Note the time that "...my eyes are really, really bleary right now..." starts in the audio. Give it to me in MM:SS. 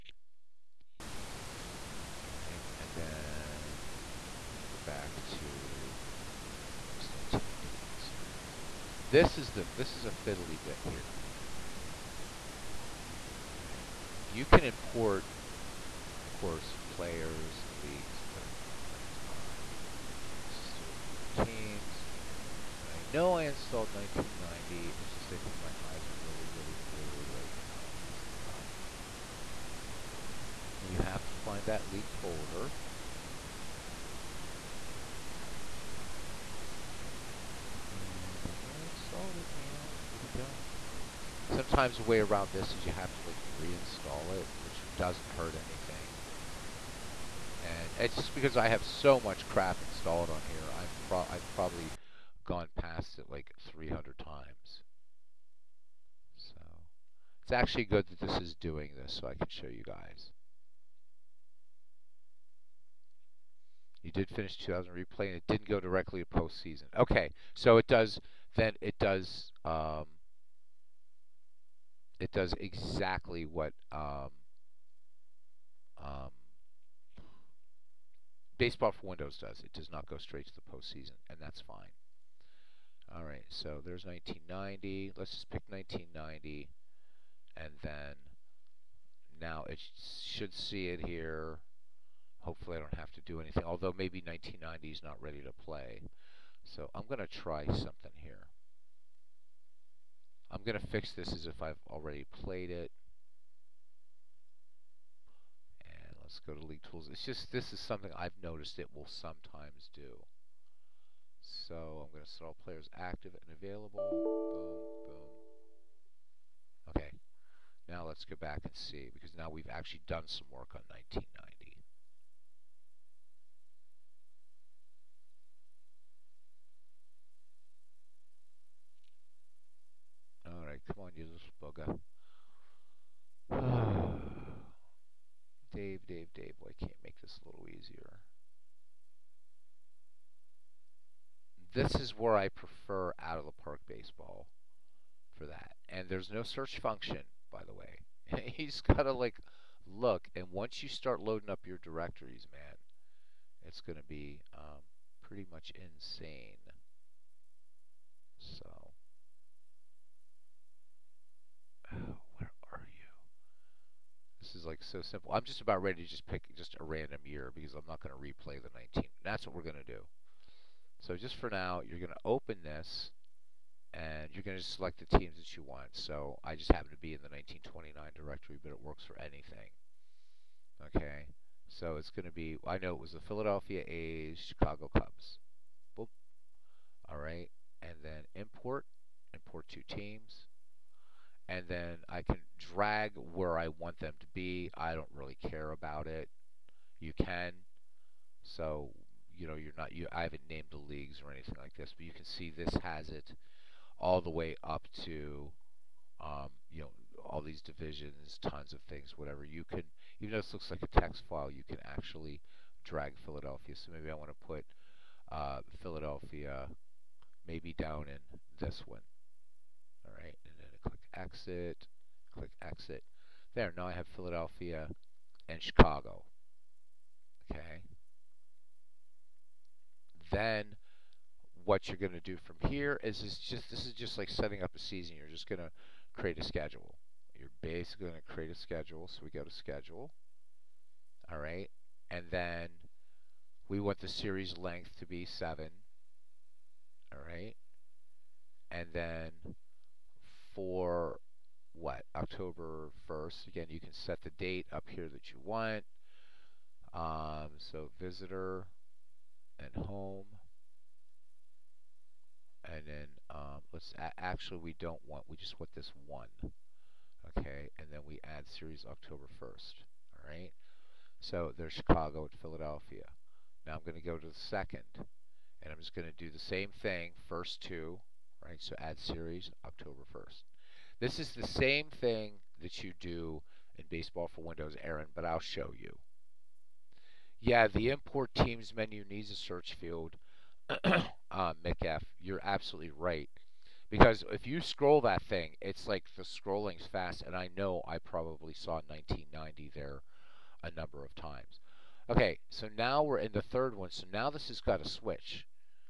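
00:25.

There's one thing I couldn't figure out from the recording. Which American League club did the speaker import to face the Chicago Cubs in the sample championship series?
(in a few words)
Philadelphia A's.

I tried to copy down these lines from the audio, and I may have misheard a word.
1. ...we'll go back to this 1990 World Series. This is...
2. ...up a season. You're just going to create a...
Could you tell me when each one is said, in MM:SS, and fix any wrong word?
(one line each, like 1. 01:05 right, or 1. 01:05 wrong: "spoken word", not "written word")
1. 00:04 right
2. 03:54 right.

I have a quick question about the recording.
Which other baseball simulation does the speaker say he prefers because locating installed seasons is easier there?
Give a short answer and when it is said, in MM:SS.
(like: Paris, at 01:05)
Out of the Park Baseball, at 02:23.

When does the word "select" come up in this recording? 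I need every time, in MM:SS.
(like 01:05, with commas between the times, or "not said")
02:54.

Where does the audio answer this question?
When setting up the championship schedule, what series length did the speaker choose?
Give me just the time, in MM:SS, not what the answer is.
04:05.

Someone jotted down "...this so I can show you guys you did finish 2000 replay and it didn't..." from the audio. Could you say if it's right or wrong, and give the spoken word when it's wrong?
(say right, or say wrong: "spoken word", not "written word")
right.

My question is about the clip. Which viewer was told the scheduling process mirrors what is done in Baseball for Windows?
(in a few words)
Aaron.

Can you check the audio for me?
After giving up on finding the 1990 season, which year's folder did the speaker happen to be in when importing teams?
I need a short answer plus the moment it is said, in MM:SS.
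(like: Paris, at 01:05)
1929, at 02:57.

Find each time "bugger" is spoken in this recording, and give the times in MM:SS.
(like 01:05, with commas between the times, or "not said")
02:13.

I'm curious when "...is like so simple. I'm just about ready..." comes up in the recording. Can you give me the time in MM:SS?
02:44.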